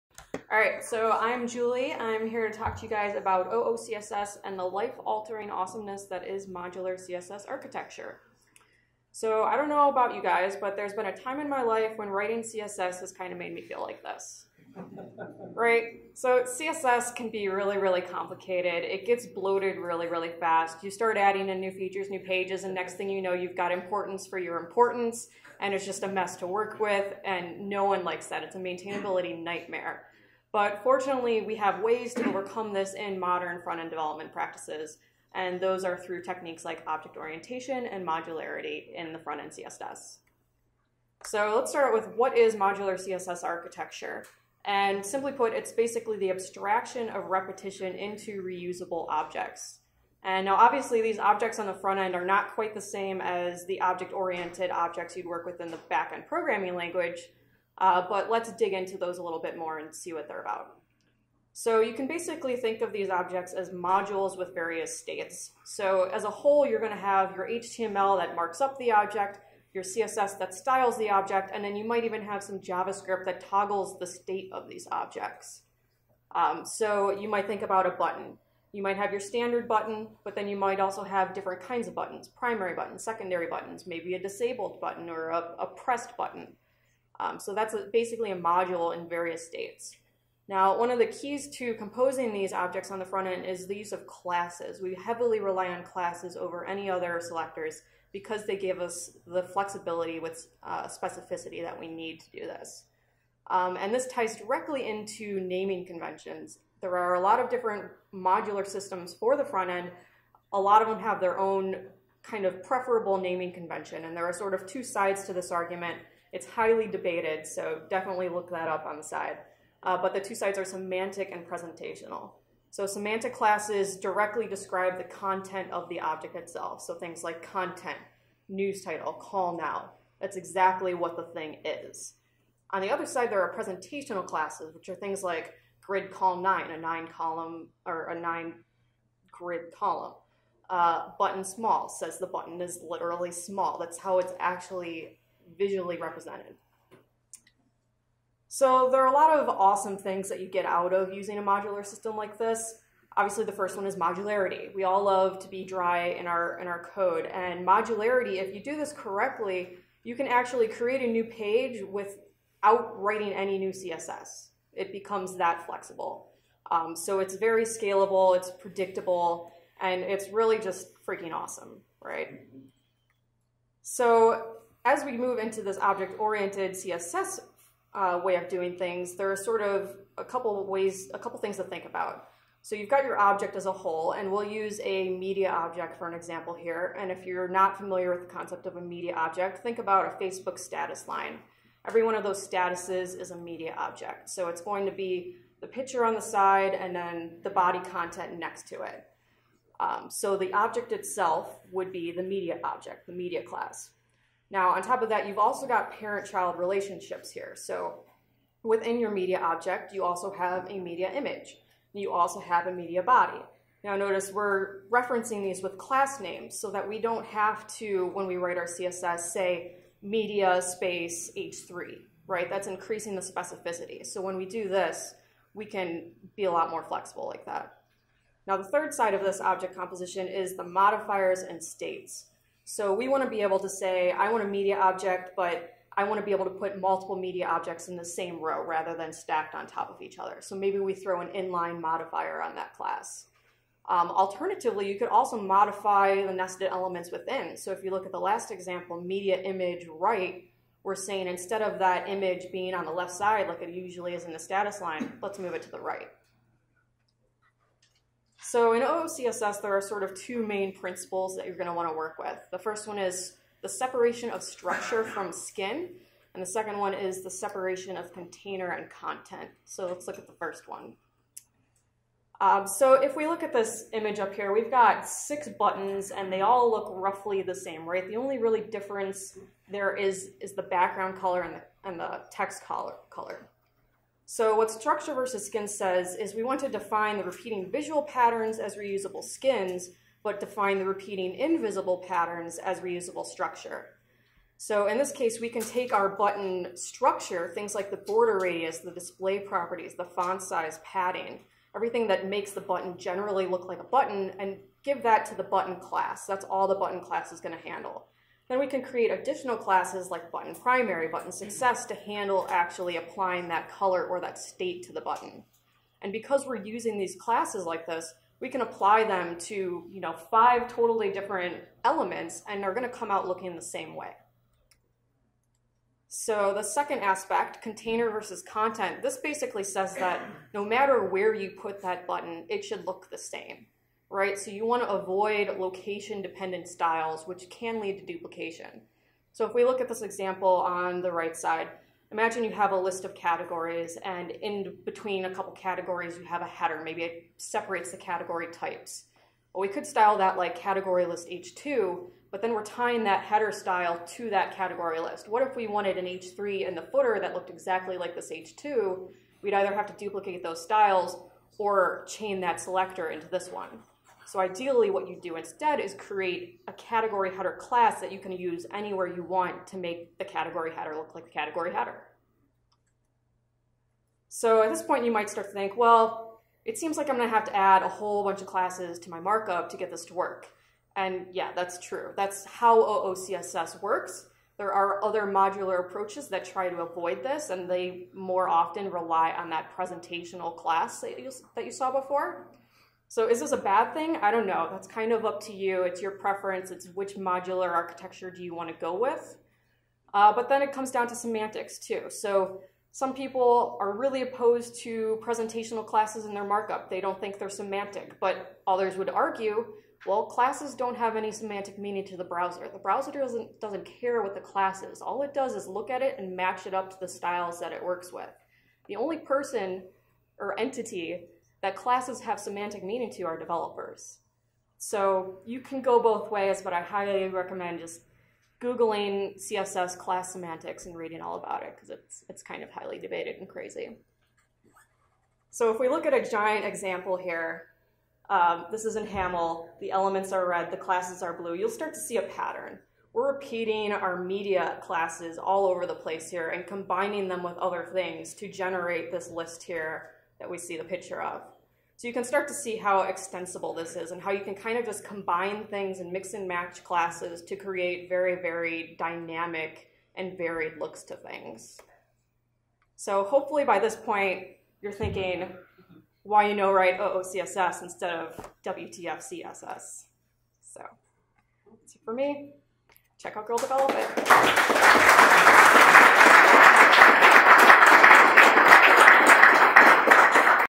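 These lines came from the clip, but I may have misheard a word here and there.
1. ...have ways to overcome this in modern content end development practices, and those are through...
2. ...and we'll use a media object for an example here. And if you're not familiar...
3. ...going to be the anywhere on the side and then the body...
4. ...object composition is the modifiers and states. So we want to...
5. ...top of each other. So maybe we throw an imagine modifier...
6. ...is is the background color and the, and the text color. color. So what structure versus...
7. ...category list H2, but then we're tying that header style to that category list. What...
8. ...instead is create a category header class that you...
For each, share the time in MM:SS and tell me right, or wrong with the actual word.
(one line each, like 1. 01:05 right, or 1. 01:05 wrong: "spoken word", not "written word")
1. 00:31 wrong: "front", not "content"
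2. 03:04 right
3. 03:14 wrong: "picture", not "anywhere"
4. 03:49 right
5. 03:59 wrong: "inline", not "imagine"
6. 04:39 right
7. 05:50 right
8. 06:05 right.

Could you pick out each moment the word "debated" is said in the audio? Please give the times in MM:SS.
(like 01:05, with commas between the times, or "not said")
01:56, 07:12.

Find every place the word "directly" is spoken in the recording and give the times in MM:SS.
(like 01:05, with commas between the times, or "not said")
01:44, 02:03.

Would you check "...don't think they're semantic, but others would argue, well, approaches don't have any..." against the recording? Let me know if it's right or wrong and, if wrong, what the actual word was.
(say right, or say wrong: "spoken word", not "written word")
wrong: "classes", not "approaches".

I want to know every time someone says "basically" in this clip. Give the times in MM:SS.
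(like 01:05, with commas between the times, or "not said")
00:45, 01:02, 01:27, 05:29.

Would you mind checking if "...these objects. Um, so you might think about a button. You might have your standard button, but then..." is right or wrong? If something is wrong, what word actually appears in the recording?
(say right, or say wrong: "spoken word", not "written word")
right.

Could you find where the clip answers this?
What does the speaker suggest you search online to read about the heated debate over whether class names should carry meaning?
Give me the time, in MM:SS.
07:09.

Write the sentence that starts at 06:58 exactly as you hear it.
The only person or entity that classes have semantic meaning to our developers.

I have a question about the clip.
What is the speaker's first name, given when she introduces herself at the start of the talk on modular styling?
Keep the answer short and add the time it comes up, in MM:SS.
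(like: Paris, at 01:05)
Julie, at 00:01.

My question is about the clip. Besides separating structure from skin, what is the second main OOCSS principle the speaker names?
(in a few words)
Separation of container and content.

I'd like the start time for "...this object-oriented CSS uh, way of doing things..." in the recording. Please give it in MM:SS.
02:55.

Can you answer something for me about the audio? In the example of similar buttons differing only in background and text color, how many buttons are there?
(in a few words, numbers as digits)
6.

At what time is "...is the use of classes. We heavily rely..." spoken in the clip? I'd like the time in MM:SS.
01:33.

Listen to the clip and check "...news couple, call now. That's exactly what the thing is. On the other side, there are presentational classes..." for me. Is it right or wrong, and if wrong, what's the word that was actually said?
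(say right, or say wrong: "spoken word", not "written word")
wrong: "title", not "couple".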